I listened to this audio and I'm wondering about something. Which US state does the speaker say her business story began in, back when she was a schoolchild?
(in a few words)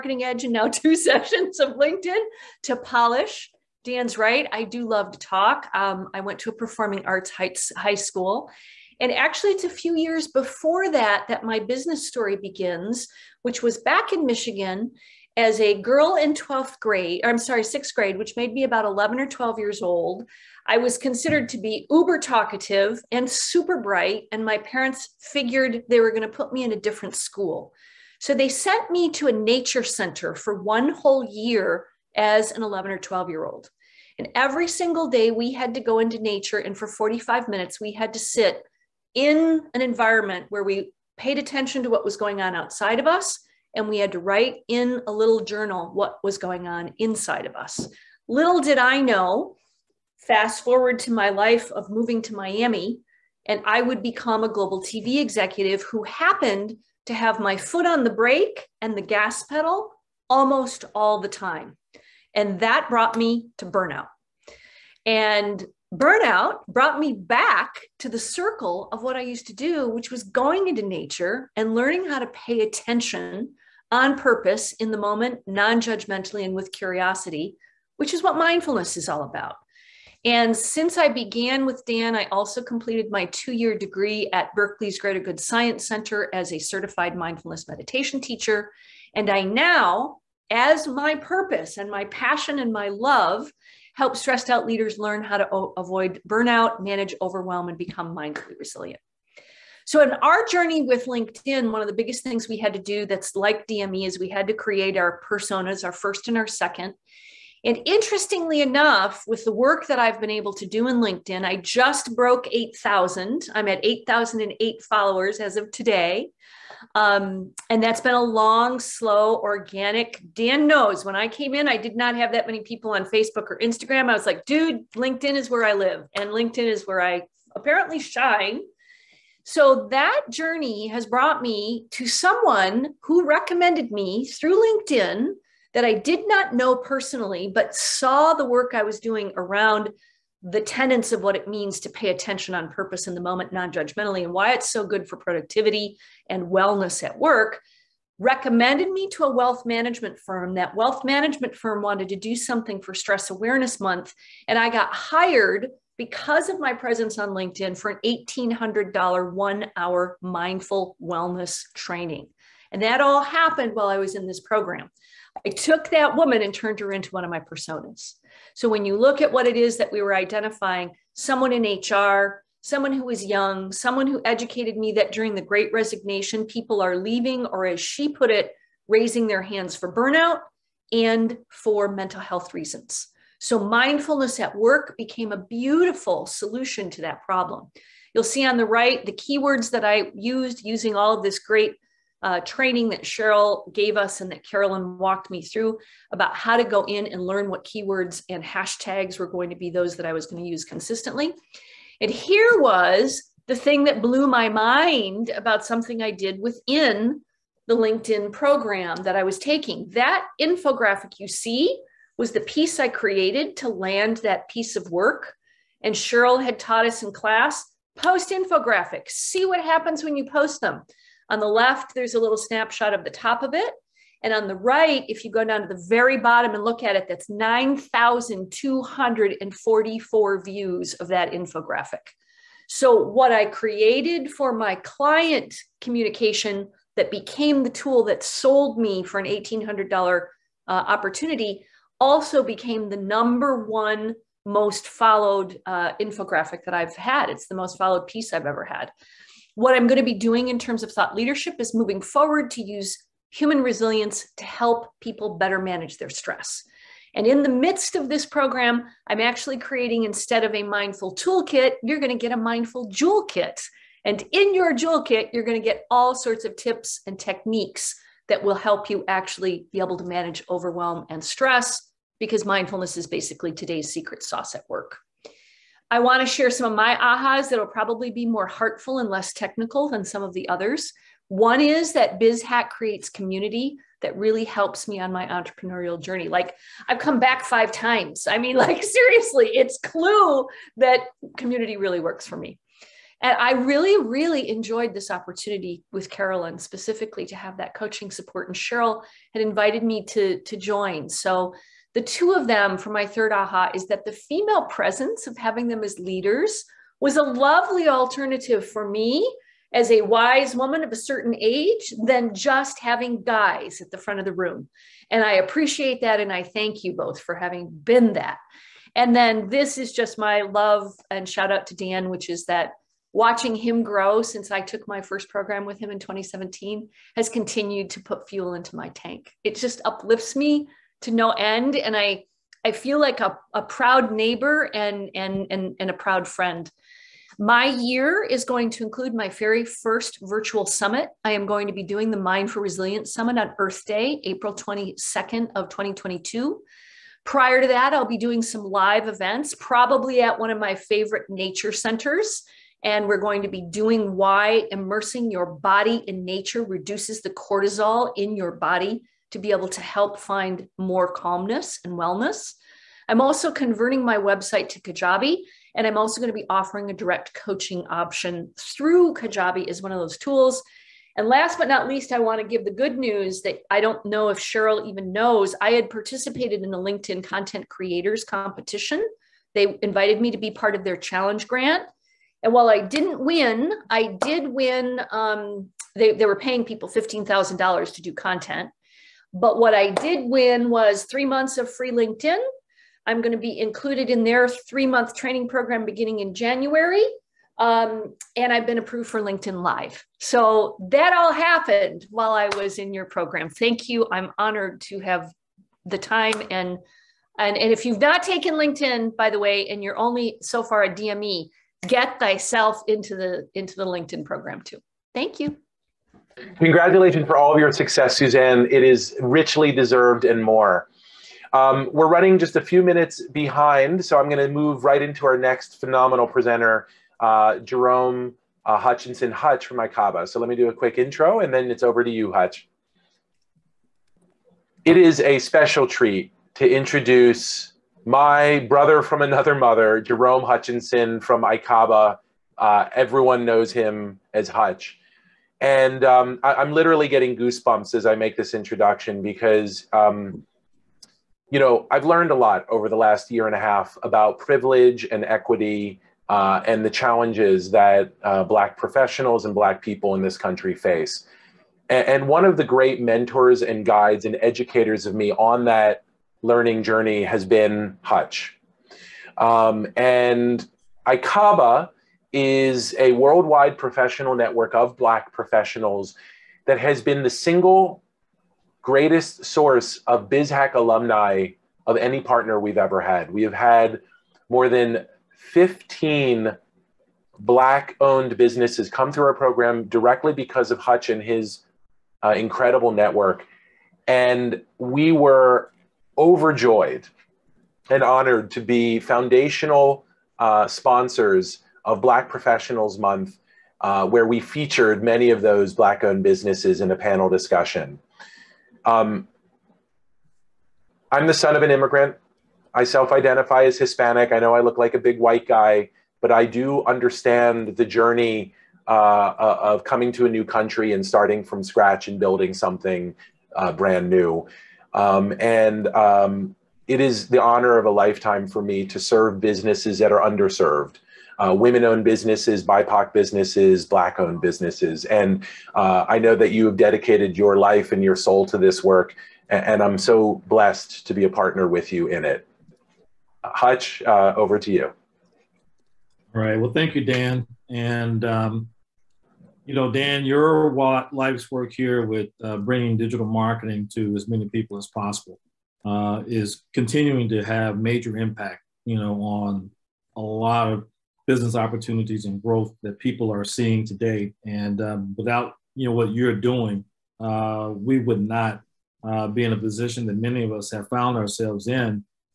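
Michigan.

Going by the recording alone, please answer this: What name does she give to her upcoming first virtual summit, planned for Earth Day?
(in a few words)
Mindful Resilience Summit.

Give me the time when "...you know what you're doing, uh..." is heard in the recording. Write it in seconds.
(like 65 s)
565 s.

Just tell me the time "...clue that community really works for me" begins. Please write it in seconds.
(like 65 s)
289 s.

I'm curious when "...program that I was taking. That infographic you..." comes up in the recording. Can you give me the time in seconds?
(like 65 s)
208 s.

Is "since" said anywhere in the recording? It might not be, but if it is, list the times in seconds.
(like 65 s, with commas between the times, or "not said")
80 s, 324 s.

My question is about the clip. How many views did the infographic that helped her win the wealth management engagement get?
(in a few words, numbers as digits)
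9,244.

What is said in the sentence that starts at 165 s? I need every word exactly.
I took that woman and turned her into one of my personas.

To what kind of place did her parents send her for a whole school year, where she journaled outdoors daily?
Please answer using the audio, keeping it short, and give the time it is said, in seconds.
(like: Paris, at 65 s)
Nature center, at 29 s.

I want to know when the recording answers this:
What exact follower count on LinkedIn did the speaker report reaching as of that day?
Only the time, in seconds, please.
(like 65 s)
113 s.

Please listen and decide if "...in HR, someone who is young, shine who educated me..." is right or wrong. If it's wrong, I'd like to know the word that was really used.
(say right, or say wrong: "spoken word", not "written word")
wrong: "someone", not "shine".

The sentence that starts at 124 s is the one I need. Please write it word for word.
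I was like, dude, LinkedIn is where I live, and LinkedIn is where I apparently shine.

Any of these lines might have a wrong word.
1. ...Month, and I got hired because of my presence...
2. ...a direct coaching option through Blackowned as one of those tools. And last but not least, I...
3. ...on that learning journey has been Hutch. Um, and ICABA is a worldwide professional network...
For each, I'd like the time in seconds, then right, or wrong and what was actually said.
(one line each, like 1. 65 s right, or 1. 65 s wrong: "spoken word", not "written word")
1. 153 s right
2. 366 s wrong: "Kajabi", not "Blackowned"
3. 465 s right.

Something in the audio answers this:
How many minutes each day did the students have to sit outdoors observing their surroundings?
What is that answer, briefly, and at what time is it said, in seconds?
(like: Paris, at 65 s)
45, at 36 s.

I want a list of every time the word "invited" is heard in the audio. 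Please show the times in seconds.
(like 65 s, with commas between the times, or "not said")
299 s, 379 s.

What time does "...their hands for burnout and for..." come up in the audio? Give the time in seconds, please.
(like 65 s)
179 s.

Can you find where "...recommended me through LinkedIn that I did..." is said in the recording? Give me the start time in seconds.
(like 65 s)
133 s.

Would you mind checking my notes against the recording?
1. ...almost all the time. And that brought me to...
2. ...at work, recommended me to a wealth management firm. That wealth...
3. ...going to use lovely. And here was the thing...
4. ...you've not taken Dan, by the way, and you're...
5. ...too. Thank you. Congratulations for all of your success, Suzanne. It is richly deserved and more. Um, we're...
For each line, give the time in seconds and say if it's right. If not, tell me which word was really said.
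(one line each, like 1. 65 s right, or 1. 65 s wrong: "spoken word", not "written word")
1. 60 s right
2. 147 s right
3. 200 s wrong: "consistently", not "lovely"
4. 407 s wrong: "LinkedIn", not "Dan"
5. 414 s right.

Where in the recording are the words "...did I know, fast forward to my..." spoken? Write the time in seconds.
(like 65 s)
48 s.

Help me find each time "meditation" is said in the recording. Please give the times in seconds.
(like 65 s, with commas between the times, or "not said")
87 s.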